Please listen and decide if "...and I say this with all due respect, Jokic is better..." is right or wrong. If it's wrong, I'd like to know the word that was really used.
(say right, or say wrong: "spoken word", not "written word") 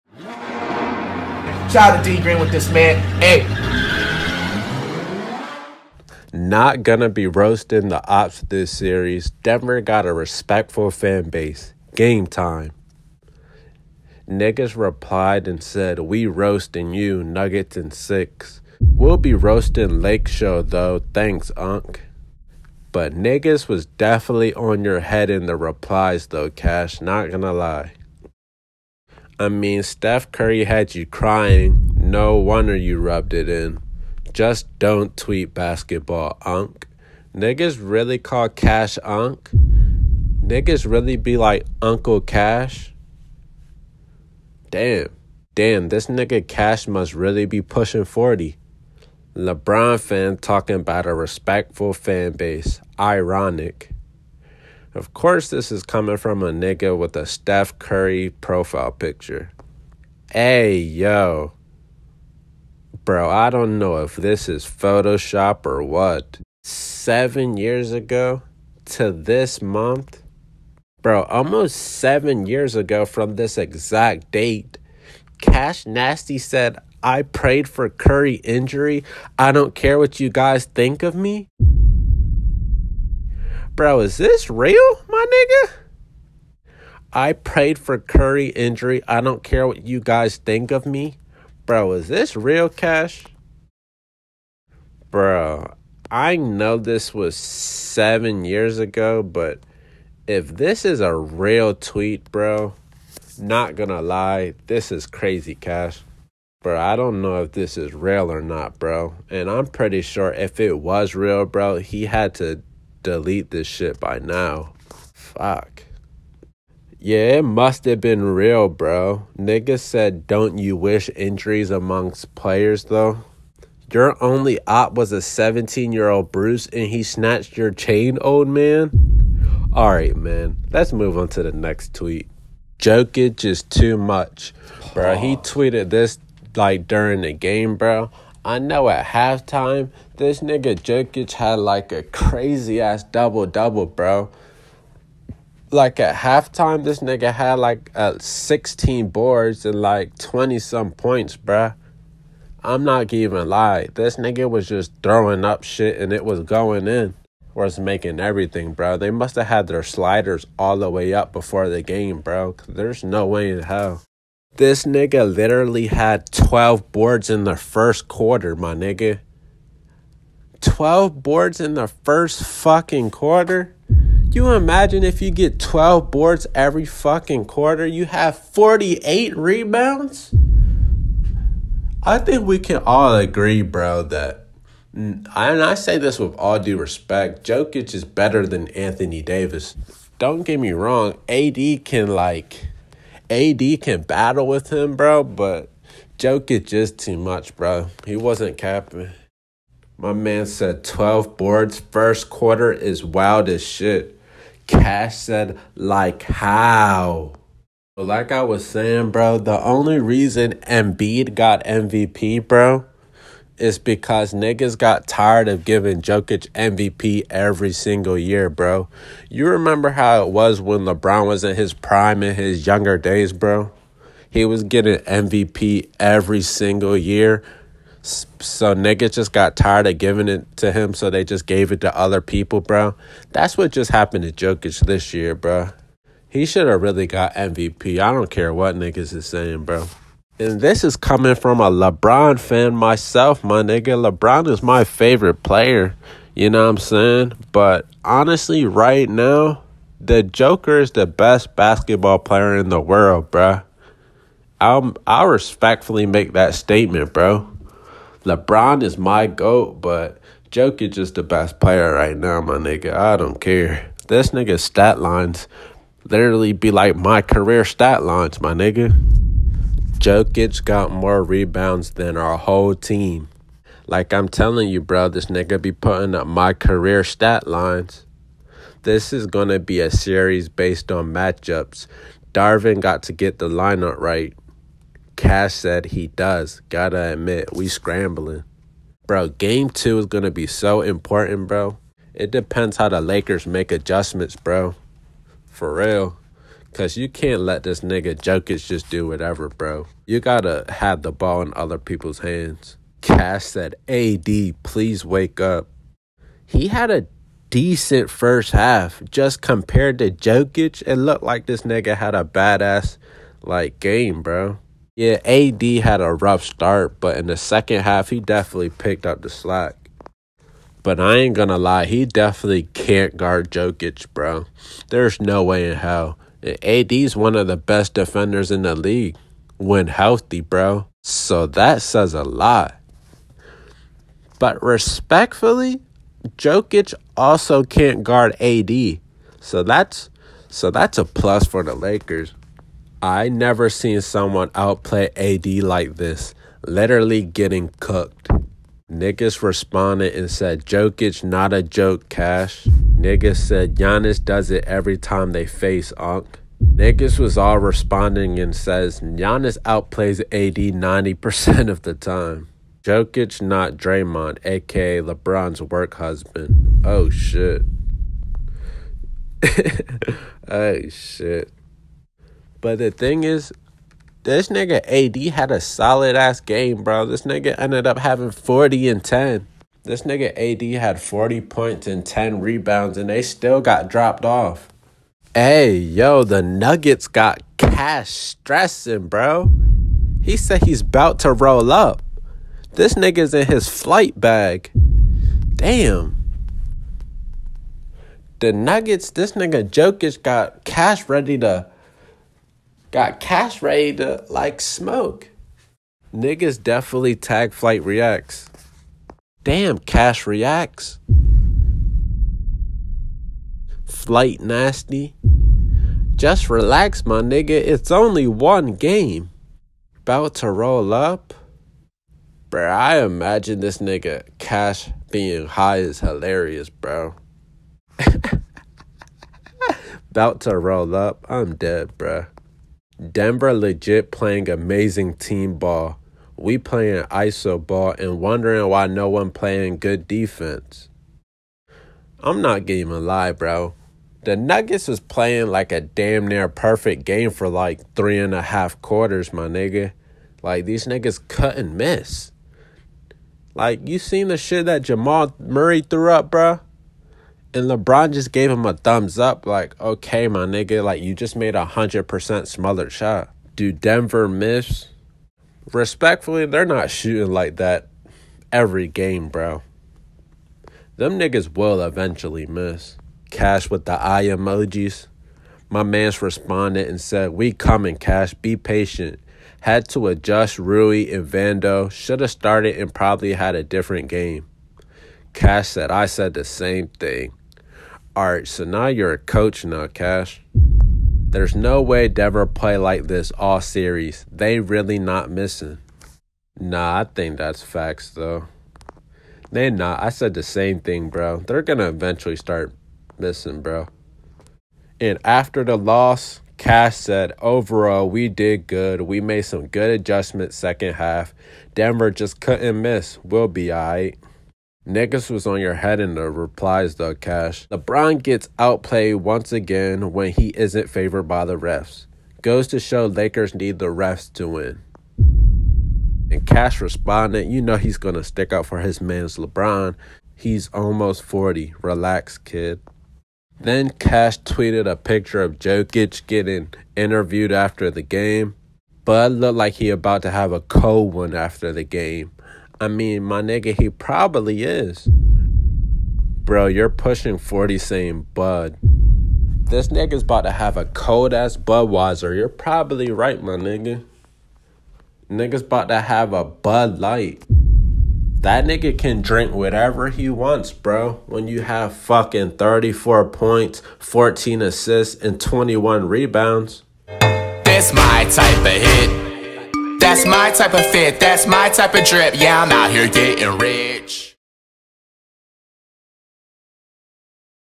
right.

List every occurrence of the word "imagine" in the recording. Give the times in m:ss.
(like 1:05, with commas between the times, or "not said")
2:54, 7:03.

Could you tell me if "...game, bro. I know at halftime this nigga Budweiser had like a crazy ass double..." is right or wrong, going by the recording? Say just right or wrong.
wrong.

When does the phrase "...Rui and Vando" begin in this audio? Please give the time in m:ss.
8:00.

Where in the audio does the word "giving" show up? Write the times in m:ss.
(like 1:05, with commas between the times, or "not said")
3:35, 3:49, 7:22.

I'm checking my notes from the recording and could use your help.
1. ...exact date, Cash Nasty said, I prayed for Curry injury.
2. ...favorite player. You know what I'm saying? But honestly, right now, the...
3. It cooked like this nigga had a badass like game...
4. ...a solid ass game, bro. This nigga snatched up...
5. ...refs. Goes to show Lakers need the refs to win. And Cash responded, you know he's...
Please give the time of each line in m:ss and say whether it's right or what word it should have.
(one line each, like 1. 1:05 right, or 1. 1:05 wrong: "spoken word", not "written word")
1. 1:13 right
2. 4:04 right
3. 5:10 wrong: "looked", not "cooked"
4. 6:15 wrong: "ended", not "snatched"
5. 8:41 right.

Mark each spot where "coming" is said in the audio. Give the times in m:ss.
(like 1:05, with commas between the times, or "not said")
0:55, 4:00, 7:57.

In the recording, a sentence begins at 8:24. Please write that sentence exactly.
And after the loss, Cash said, overall, we did good.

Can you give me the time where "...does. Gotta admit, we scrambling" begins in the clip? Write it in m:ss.
4:46.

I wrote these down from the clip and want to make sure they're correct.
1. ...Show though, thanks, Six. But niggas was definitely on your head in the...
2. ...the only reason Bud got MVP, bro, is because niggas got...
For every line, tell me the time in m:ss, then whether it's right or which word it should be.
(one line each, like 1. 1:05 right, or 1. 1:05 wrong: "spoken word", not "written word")
1. 0:20 wrong: "Unc", not "Six"
2. 3:29 wrong: "Embiid", not "Bud".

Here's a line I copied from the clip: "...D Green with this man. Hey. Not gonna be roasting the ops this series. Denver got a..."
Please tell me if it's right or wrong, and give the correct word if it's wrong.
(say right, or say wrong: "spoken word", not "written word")
right.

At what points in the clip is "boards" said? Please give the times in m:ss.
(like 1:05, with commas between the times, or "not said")
2:29, 2:46, 2:51, 2:56, 3:21.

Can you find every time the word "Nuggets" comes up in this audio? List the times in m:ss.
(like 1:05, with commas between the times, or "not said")
0:17, 6:26, 6:38, 7:24.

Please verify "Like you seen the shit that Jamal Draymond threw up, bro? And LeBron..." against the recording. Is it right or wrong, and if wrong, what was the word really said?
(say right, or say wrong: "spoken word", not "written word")
wrong: "Murray", not "Draymond".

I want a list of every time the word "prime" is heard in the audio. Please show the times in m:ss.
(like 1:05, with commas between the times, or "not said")
3:41.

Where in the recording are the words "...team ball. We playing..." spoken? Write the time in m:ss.
7:15.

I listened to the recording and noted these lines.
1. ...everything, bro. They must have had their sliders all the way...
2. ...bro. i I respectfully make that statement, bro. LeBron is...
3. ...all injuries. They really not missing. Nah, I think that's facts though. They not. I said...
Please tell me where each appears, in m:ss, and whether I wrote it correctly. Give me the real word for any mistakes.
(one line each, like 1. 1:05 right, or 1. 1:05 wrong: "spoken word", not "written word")
1. 2:38 right
2. 4:13 right
3. 8:13 wrong: "series", not "injuries".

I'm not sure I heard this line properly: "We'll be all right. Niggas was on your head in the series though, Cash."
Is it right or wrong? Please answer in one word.
wrong.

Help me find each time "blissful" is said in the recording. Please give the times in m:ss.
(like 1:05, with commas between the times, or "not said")
not said.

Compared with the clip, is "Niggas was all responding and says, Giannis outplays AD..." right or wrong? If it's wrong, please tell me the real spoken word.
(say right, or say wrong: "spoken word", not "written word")
right.